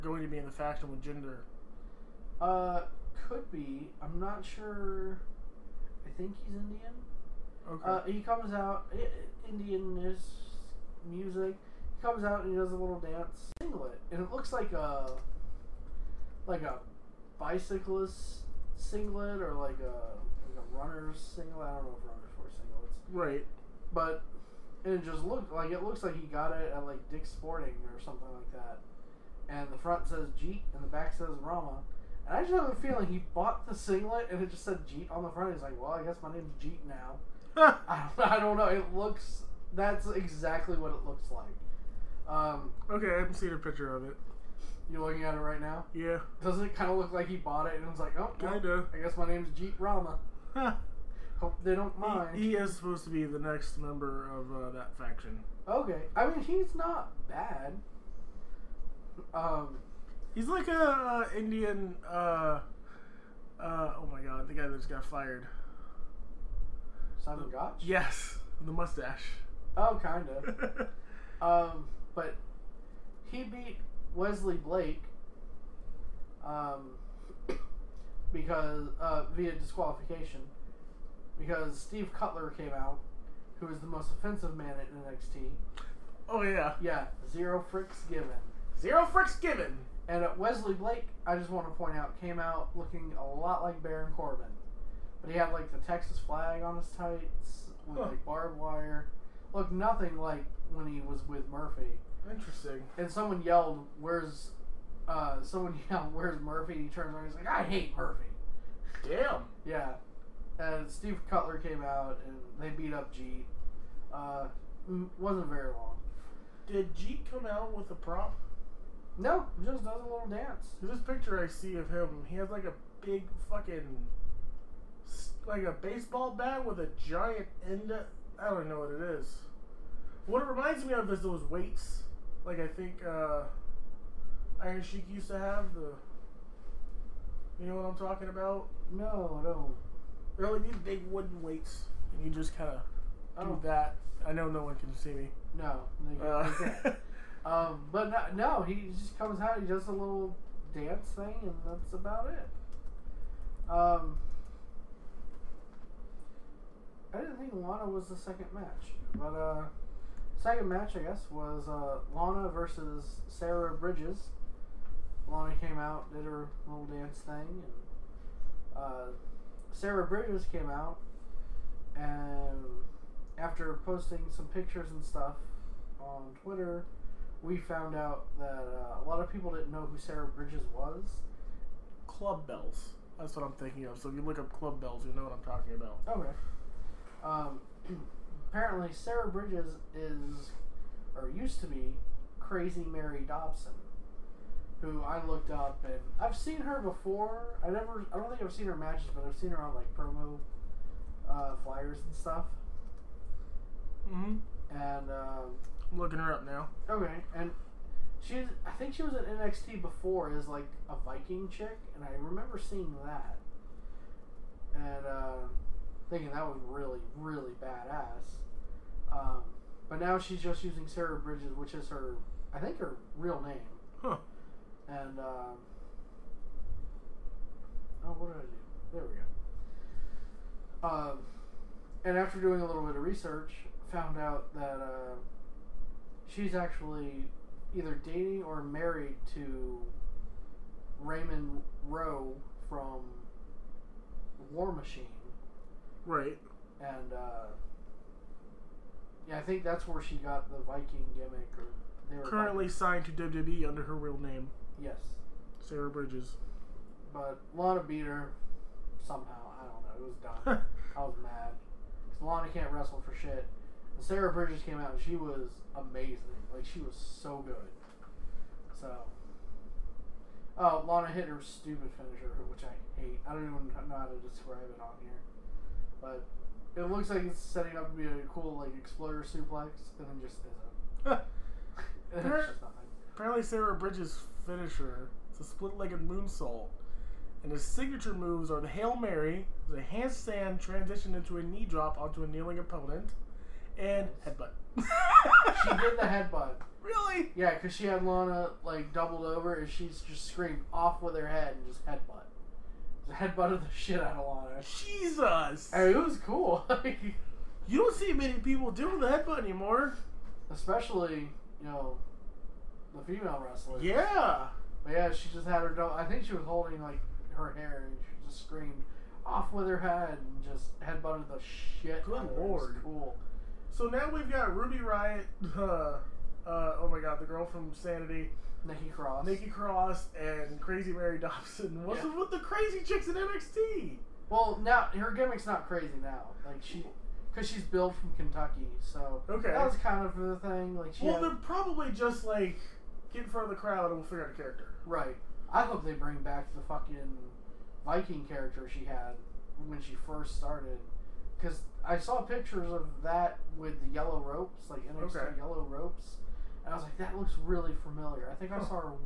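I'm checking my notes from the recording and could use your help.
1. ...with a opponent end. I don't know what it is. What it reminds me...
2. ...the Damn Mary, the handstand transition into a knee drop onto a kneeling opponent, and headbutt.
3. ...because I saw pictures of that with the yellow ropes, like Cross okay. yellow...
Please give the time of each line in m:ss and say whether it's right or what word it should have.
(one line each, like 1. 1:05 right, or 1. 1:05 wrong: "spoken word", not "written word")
1. 2:06 wrong: "giant", not "opponent"
2. 4:48 wrong: "Hail", not "Damn"
3. 5:51 wrong: "NXT", not "Cross".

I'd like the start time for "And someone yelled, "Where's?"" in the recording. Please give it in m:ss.
1:42.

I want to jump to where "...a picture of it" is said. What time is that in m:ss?
0:43.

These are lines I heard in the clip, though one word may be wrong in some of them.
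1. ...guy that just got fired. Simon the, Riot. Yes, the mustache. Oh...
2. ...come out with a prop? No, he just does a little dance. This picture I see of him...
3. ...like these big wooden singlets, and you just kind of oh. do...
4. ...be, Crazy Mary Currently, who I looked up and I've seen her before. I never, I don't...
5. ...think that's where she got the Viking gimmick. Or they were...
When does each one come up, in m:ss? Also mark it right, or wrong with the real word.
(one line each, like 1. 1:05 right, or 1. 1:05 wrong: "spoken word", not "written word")
1. 1:04 wrong: "Gotch", not "Riot"
2. 1:57 right
3. 2:20 wrong: "weights", not "singlets"
4. 3:11 wrong: "Dobson", not "Currently"
5. 4:09 right.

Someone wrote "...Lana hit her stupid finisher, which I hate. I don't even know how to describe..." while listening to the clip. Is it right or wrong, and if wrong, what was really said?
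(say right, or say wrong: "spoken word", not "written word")
right.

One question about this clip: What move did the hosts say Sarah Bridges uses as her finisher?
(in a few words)
split-legged moonsault.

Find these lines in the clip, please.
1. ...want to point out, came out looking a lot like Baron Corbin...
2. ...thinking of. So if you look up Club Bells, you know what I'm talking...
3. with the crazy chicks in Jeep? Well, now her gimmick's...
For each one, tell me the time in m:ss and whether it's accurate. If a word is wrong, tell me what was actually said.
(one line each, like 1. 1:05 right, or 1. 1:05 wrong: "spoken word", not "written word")
1. 1:31 right
2. 3:03 right
3. 5:32 wrong: "NXT", not "Jeep".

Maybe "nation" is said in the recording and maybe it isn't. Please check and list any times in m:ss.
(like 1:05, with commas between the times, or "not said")
not said.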